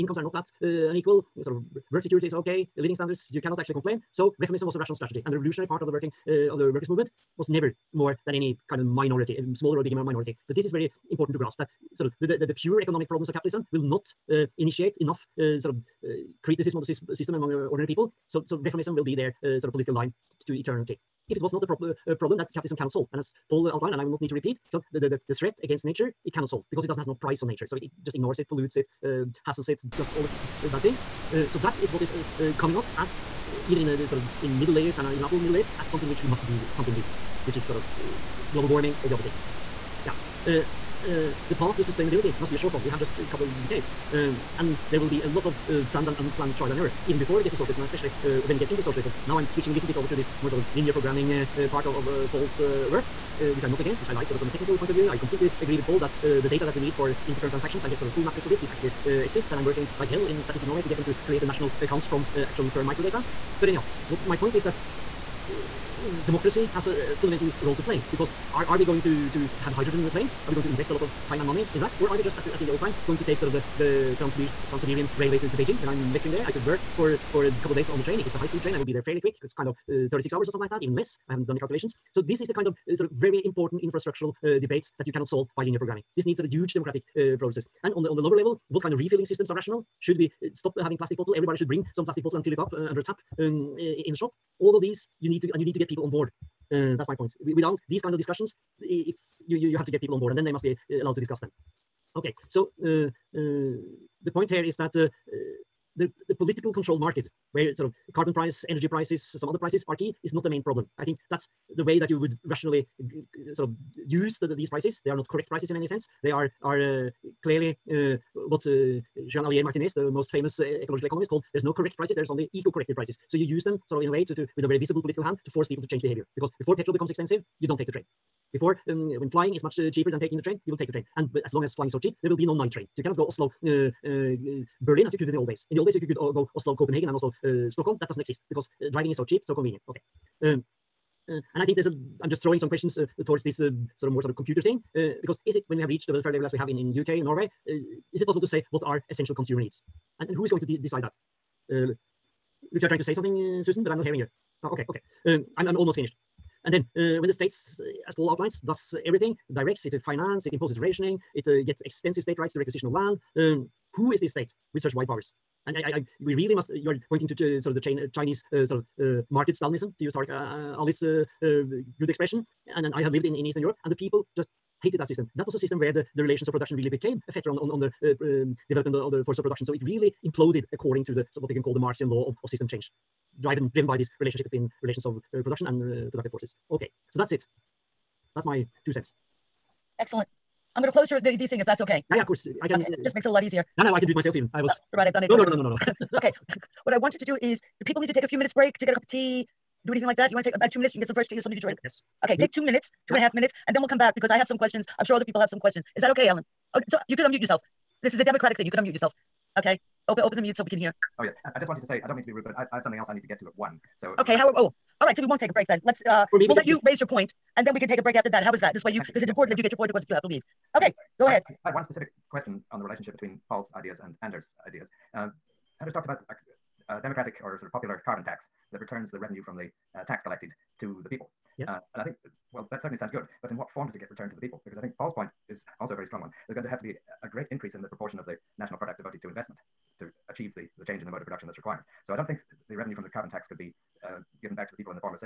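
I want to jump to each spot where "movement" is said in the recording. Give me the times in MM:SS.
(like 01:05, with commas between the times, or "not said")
00:06.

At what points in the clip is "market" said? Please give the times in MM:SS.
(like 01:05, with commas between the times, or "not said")
01:46, 02:49.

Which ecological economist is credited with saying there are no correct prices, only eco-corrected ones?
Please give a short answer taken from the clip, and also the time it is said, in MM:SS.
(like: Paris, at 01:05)
Joan Alier Martinez, at 01:59.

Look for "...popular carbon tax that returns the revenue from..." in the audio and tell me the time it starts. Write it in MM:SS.
03:47.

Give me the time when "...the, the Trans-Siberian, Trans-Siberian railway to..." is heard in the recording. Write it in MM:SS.
01:13.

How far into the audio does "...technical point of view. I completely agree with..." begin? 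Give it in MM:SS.
00:54.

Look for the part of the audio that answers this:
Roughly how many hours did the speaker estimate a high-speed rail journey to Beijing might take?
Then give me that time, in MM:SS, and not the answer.
01:20.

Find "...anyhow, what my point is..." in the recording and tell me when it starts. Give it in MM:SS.
01:03.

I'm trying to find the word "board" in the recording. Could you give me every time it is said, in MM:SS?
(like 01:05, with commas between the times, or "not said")
01:36, 01:40.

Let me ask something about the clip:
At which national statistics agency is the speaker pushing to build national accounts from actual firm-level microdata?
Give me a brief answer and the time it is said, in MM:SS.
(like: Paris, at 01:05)
Statistics Norway, at 01:00.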